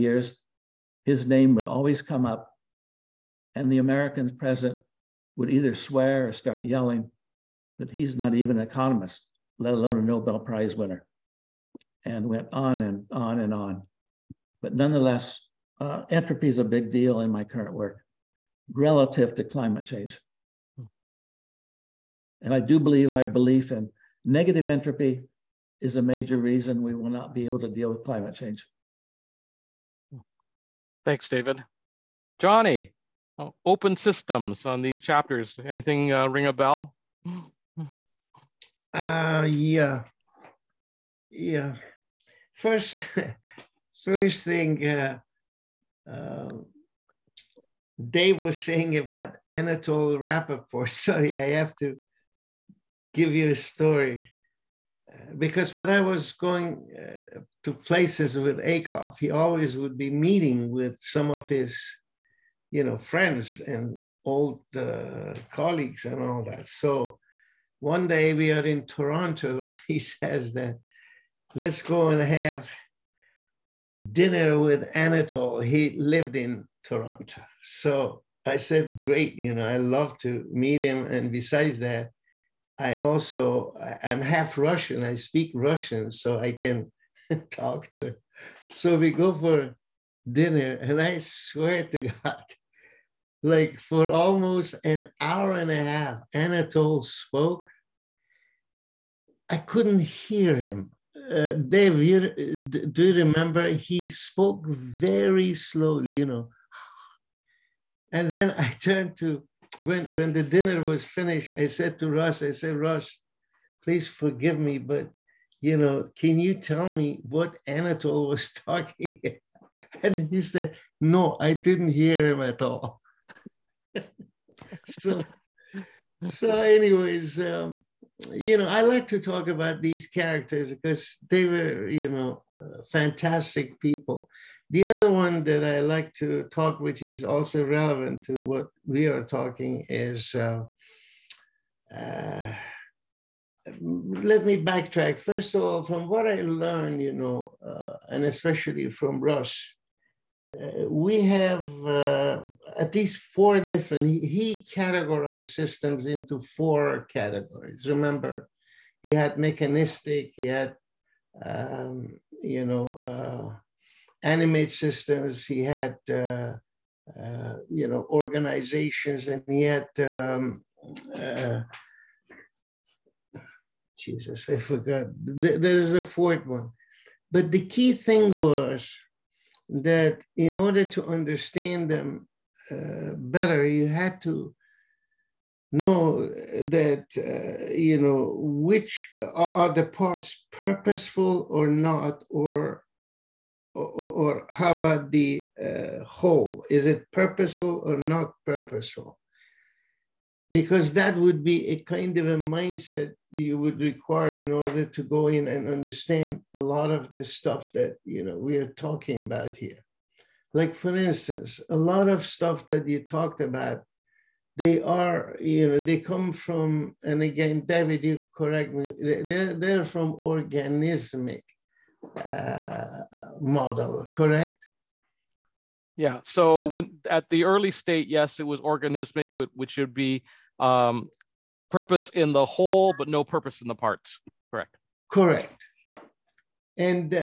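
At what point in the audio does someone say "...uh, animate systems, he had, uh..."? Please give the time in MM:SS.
02:42.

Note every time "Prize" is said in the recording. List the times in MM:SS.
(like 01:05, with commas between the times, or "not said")
00:10.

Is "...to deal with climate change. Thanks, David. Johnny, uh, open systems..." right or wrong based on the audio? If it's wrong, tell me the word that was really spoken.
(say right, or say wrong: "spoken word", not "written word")
right.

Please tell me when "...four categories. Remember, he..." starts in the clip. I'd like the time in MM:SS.
02:36.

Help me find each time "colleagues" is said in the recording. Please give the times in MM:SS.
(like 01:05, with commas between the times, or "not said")
01:05.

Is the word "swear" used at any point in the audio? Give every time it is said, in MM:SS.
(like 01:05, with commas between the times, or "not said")
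00:05, 01:31.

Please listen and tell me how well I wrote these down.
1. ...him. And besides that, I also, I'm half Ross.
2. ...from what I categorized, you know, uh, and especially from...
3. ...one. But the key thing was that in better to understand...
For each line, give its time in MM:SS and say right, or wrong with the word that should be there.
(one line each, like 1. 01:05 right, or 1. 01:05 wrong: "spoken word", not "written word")
1. 01:20 wrong: "Russian", not "Ross"
2. 02:25 wrong: "learned", not "categorized"
3. 02:56 wrong: "order", not "better".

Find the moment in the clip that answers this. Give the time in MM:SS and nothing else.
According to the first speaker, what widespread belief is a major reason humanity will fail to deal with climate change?
00:24.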